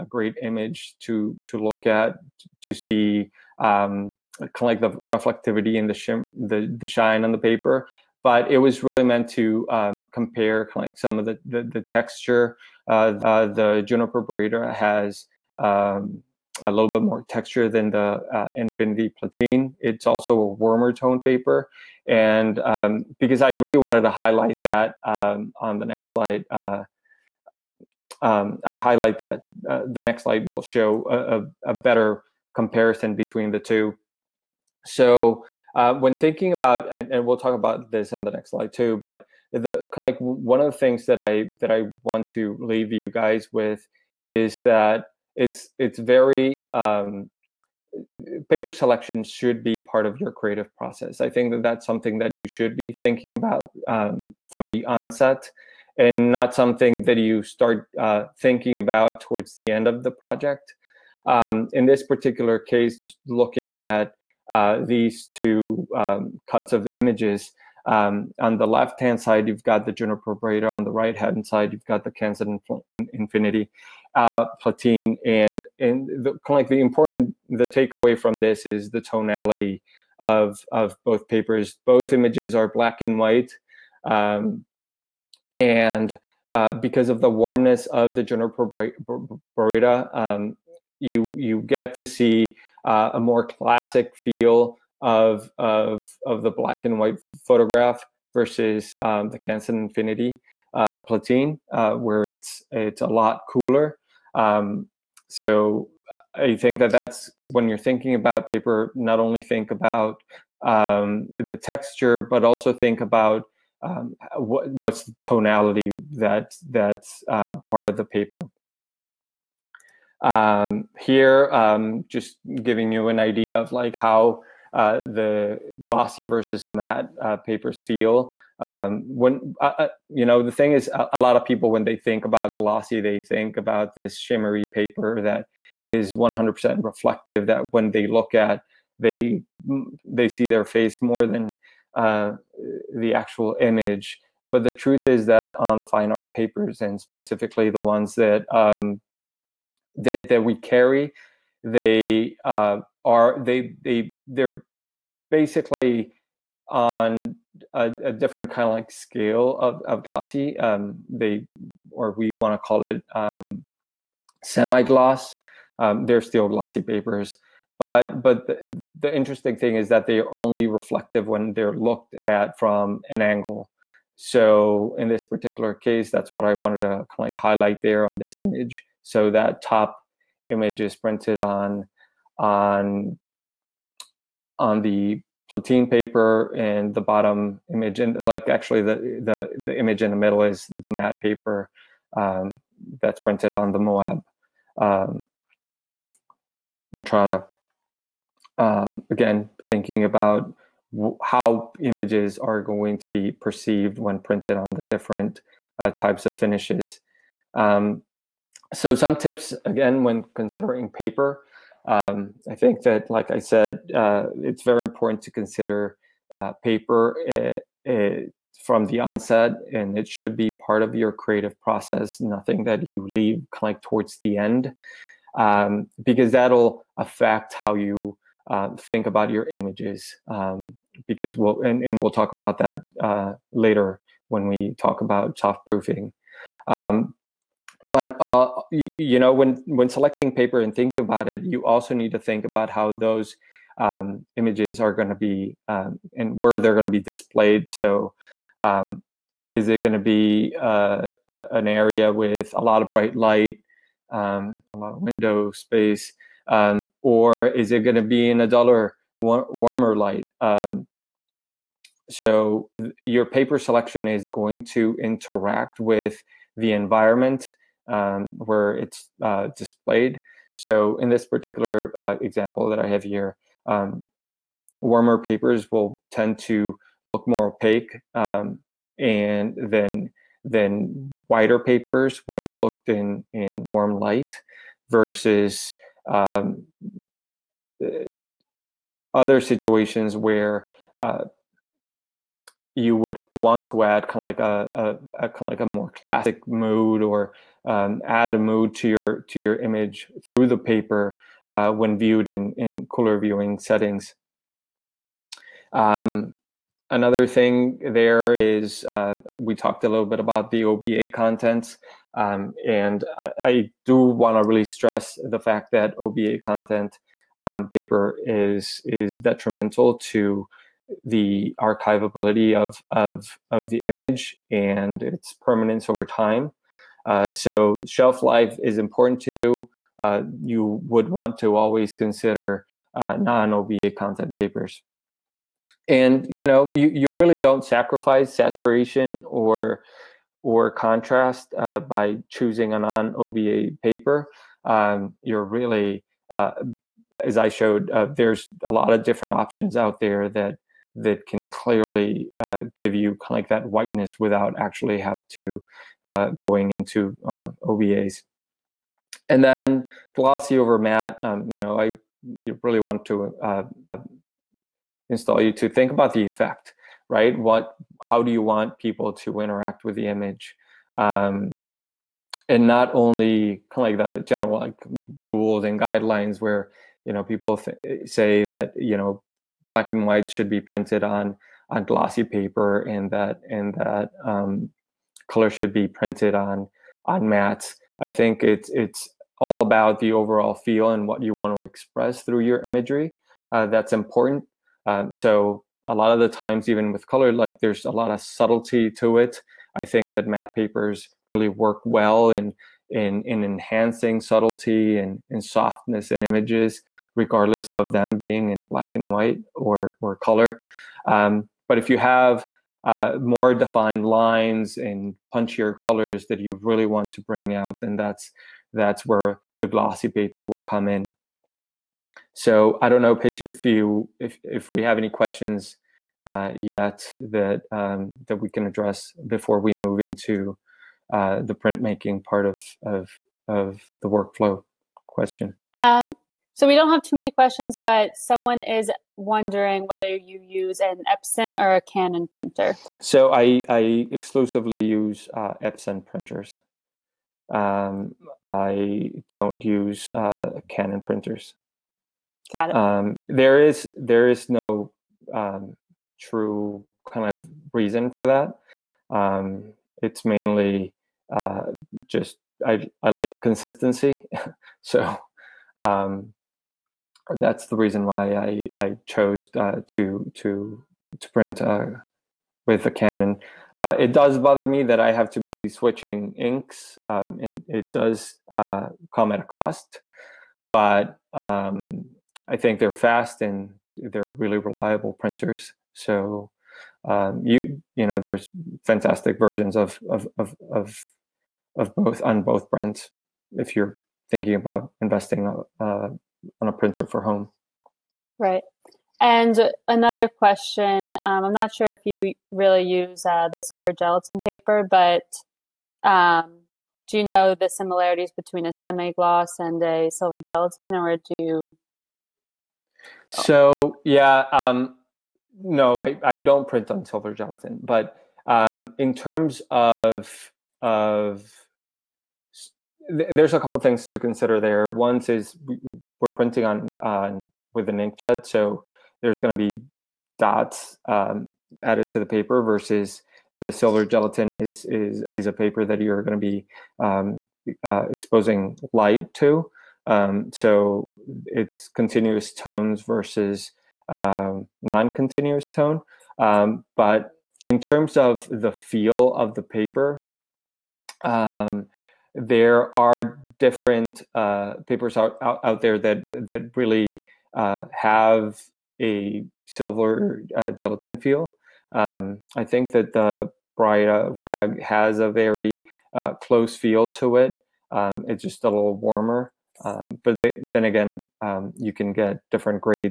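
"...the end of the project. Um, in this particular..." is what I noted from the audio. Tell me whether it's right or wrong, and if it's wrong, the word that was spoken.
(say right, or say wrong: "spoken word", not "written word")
right.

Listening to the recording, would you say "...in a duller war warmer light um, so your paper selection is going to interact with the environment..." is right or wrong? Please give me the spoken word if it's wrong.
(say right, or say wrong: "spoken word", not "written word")
right.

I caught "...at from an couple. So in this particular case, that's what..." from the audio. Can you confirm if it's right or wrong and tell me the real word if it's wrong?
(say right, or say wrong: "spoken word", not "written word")
wrong: "angle", not "couple".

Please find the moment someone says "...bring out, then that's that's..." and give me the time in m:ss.
6:57.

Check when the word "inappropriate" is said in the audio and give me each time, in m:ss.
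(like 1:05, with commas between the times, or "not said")
not said.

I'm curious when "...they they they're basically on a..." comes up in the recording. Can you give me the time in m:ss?
2:33.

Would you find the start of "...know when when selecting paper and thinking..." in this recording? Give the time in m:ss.
3:59.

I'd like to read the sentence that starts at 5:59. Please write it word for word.
And then glossy over matte, um, you know, I you really want to uh, install you to think about the effect, right?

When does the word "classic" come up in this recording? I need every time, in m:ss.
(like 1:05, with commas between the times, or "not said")
1:33, 4:55.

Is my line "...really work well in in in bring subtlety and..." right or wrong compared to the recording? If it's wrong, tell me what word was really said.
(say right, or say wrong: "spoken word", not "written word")
wrong: "enhancing", not "bring".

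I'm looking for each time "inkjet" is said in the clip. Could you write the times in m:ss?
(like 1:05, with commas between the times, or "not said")
8:47.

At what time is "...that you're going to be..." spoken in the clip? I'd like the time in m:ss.
8:55.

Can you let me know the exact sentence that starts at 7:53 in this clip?
Uh, it does bother me that I have to be switching inks, um, and it does uh, come at a cost.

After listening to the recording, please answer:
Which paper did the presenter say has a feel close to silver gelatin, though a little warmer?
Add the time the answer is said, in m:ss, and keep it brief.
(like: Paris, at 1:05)
Baryta rag, at 9:23.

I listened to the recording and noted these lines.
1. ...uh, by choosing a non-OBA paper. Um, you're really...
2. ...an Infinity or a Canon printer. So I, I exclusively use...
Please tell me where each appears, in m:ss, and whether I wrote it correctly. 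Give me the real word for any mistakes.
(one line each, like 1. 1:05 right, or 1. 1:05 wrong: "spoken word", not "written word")
1. 5:41 right
2. 7:20 wrong: "Epson", not "Infinity".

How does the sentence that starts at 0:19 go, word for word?
It's also a warmer tone paper.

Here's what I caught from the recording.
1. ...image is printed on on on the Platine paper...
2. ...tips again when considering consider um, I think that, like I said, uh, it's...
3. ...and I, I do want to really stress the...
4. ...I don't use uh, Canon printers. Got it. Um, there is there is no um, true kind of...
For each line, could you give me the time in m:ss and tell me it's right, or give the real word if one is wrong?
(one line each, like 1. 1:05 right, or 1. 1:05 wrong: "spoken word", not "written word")
1. 3:00 right
2. 3:29 wrong: "paper", not "consider"
3. 5:12 right
4. 7:28 right.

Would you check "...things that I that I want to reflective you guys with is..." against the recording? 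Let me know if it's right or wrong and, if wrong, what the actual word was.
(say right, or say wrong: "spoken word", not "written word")
wrong: "leave", not "reflective".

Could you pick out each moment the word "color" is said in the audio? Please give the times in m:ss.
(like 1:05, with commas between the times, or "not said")
6:25, 6:37, 6:50, 6:55.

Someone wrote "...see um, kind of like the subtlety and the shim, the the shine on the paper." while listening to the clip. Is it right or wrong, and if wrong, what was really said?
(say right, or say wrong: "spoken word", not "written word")
wrong: "reflectivity", not "subtlety".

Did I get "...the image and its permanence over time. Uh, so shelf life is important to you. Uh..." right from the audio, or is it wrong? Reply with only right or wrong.
right.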